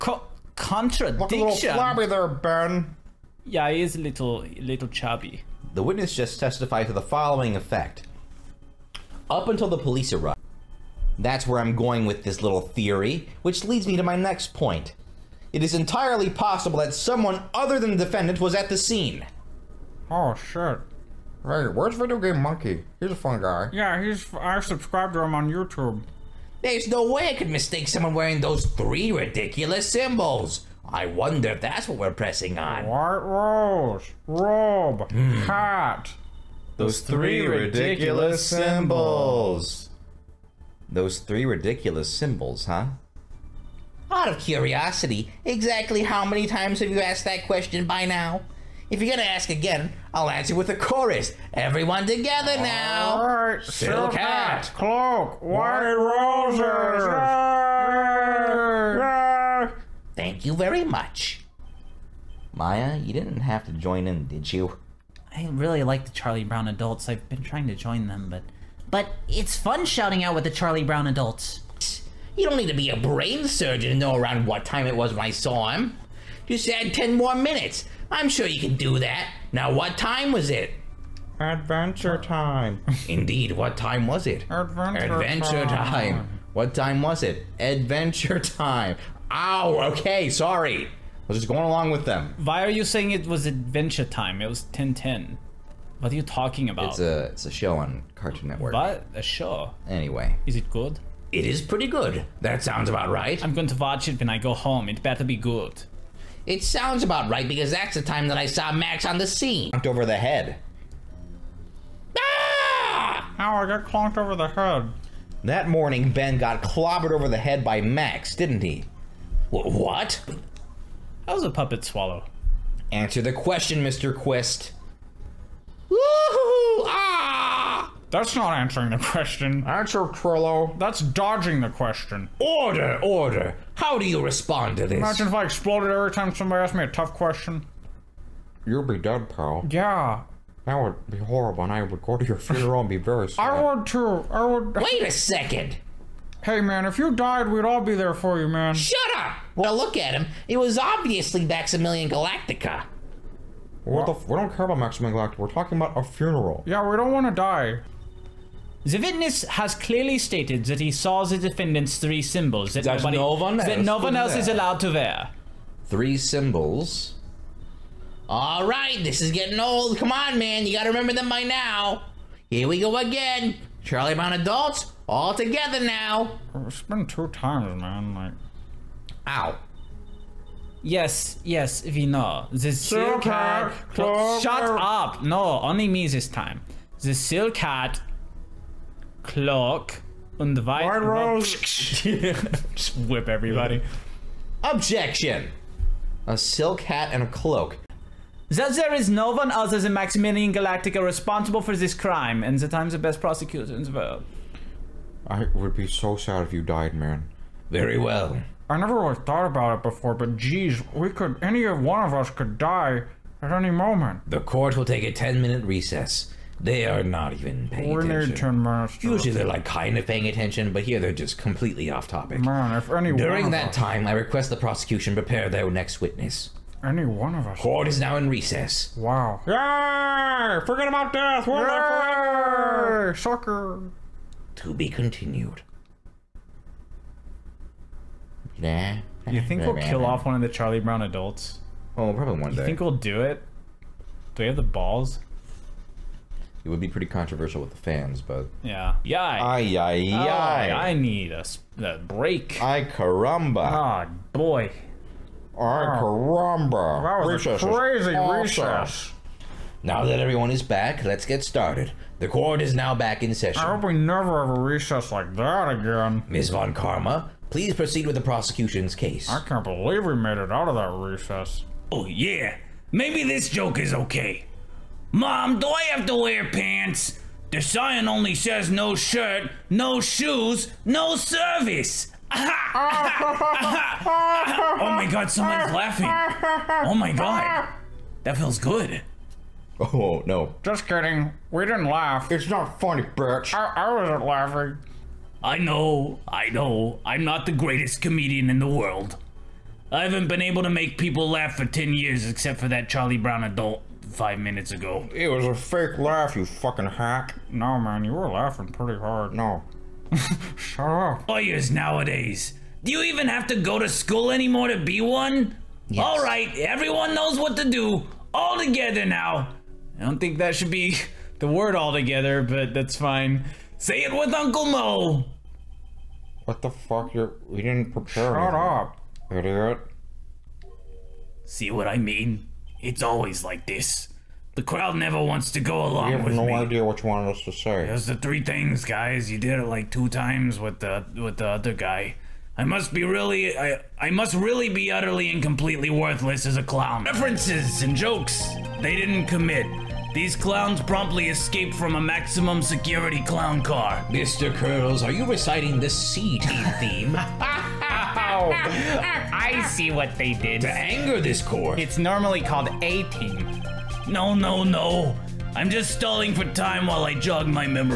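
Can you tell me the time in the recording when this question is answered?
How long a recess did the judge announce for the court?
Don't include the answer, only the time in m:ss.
3:35.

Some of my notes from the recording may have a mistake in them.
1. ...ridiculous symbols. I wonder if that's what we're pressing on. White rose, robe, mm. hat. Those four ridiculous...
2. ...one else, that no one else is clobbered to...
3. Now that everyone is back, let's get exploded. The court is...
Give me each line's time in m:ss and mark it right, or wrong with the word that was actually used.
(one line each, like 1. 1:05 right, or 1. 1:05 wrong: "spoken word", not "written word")
1. 0:29 wrong: "three", not "four"
2. 2:43 wrong: "allowed", not "clobbered"
3. 4:19 wrong: "started", not "exploded".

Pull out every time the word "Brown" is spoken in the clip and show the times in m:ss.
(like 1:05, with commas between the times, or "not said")
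1:06, 1:10, 2:54, 4:00, 5:03.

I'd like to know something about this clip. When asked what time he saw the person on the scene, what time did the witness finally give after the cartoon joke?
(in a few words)
10:10.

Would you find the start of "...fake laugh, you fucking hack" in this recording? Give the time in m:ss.
5:05.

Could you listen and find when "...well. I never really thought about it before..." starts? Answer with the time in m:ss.
3:27.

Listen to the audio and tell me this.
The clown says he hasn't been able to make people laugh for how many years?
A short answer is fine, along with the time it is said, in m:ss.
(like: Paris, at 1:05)
10, at 5:01.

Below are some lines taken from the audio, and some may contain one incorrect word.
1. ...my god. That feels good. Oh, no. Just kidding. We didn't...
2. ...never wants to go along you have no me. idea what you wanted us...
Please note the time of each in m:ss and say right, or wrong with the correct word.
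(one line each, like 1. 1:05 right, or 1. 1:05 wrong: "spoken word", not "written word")
1. 4:46 right
2. 5:34 right.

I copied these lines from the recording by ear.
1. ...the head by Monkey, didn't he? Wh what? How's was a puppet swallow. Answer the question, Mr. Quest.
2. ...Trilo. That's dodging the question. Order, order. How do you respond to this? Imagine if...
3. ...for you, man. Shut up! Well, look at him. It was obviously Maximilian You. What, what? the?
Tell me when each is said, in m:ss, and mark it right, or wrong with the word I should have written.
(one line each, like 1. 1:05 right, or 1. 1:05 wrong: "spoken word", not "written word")
1. 1:57 wrong: "Max", not "Monkey"
2. 2:10 right
3. 2:28 wrong: "Galactica", not "You".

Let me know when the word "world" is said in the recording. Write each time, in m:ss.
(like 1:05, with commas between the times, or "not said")
3:23, 4:58.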